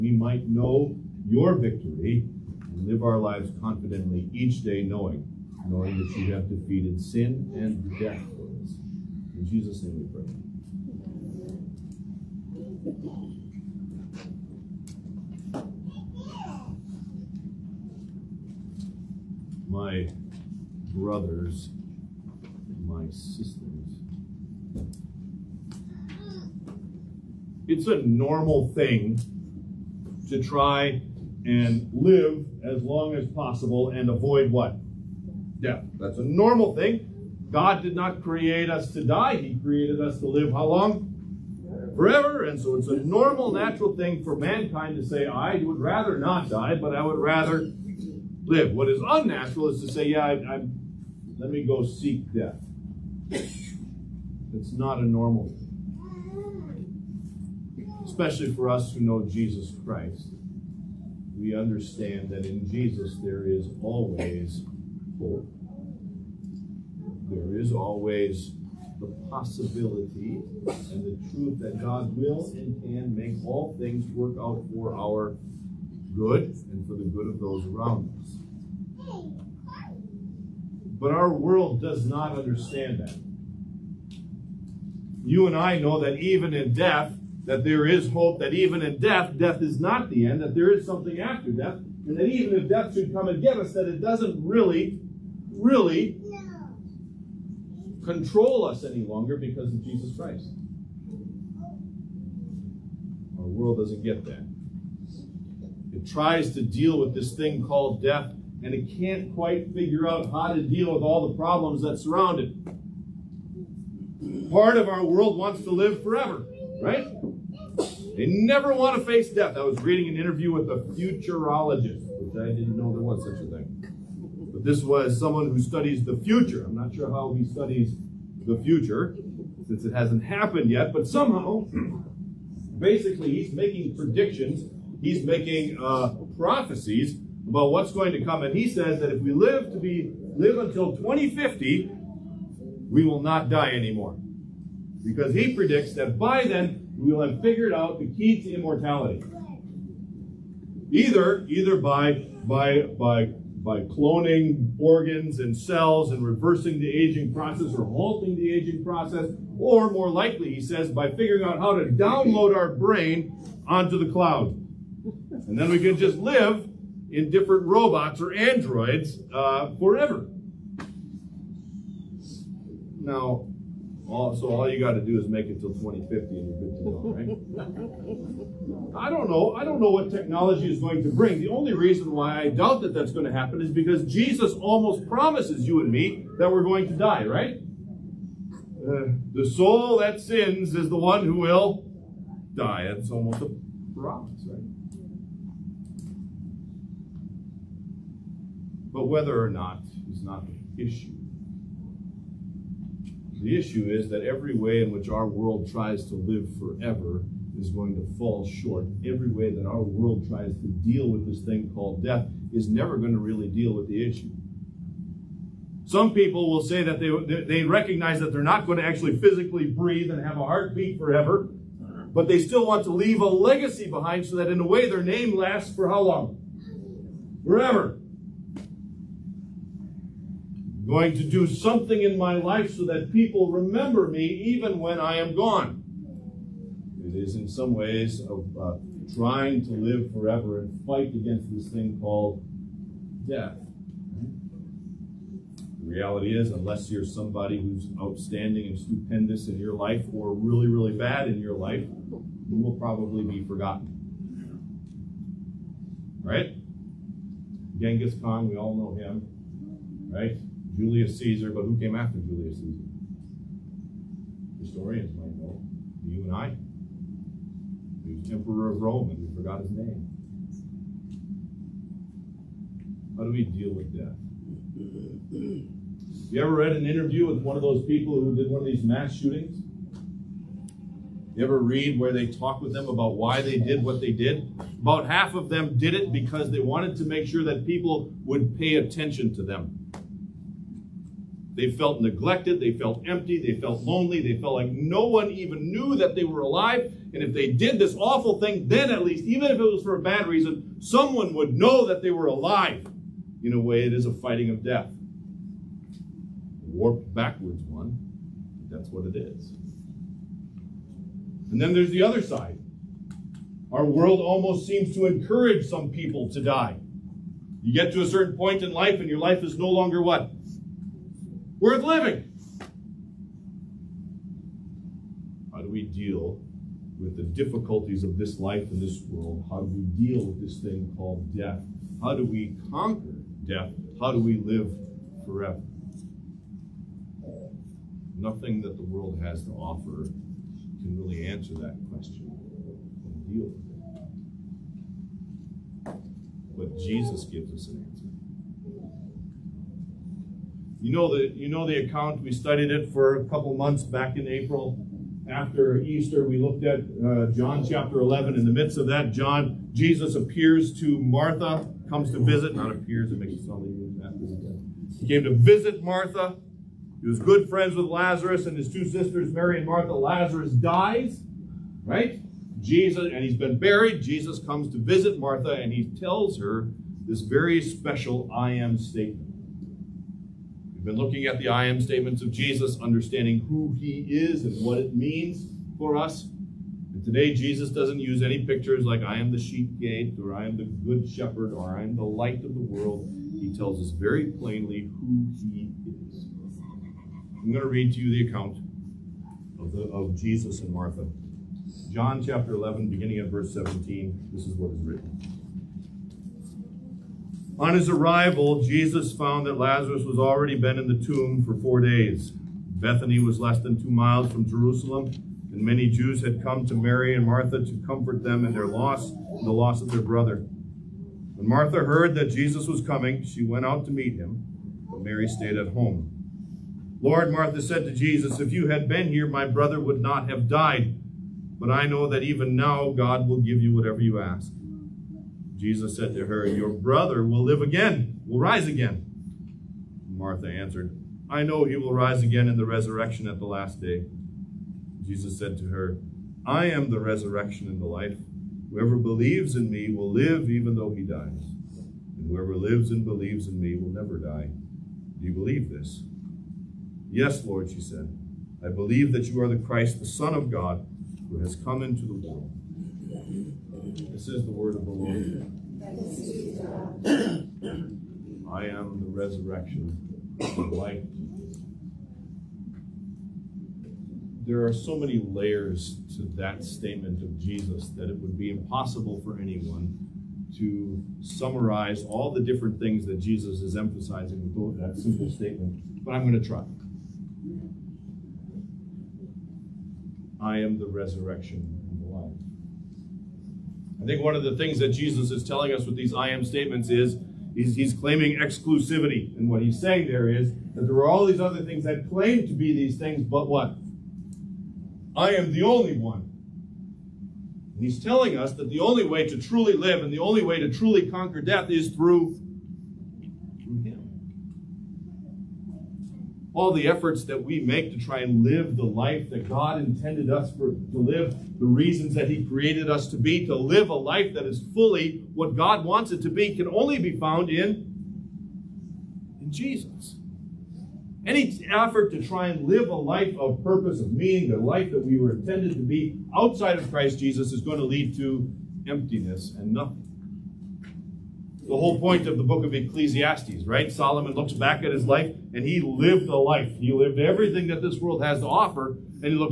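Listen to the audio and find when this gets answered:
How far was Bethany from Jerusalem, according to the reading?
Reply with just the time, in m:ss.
6:53.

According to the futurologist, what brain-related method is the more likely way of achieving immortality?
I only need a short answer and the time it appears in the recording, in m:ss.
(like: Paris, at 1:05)
download our brain onto the cloud, at 2:41.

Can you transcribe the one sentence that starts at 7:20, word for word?
Martha answered, I know he will rise again in the resurrection at the last day.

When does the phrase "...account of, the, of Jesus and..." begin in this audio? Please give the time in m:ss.
6:38.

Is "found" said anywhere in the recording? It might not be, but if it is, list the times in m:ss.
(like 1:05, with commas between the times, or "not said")
6:49, 8:47.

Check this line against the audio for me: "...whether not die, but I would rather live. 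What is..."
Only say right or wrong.
wrong.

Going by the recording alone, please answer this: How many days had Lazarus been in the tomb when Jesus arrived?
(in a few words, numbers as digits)
4.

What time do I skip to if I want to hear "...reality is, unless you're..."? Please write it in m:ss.
4:05.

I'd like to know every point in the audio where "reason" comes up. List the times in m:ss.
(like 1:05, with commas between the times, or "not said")
3:01, 5:00, 8:41.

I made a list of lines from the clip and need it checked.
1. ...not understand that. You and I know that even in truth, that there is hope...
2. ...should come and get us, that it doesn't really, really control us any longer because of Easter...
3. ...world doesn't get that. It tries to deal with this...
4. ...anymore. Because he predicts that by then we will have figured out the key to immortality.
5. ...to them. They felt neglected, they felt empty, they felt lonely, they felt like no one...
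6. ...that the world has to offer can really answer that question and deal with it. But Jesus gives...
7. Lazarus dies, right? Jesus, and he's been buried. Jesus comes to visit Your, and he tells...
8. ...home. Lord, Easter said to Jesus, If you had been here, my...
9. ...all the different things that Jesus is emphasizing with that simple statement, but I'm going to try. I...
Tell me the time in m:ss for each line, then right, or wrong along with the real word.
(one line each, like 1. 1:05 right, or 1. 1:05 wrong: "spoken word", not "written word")
1. 1:22 wrong: "death", not "truth"
2. 1:32 wrong: "Jesus", not "Easter"
3. 1:43 right
4. 2:23 right
5. 4:49 right
6. 5:38 right
7. 6:09 wrong: "Martha", not "Your"
8. 7:05 wrong: "Martha", not "Easter"
9. 8:02 right.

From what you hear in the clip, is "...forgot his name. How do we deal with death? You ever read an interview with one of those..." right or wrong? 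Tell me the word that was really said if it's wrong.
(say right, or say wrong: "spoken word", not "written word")
right.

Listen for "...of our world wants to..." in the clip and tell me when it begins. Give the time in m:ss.
1:54.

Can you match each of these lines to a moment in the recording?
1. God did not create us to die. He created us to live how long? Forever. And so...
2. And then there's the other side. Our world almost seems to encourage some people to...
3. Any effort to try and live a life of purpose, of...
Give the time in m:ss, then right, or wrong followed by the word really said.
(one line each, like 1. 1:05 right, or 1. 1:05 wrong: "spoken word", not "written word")
1. 0:37 right
2. 5:11 right
3. 8:51 right.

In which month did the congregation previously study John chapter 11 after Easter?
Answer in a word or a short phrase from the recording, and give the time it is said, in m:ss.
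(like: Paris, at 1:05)
April, at 5:54.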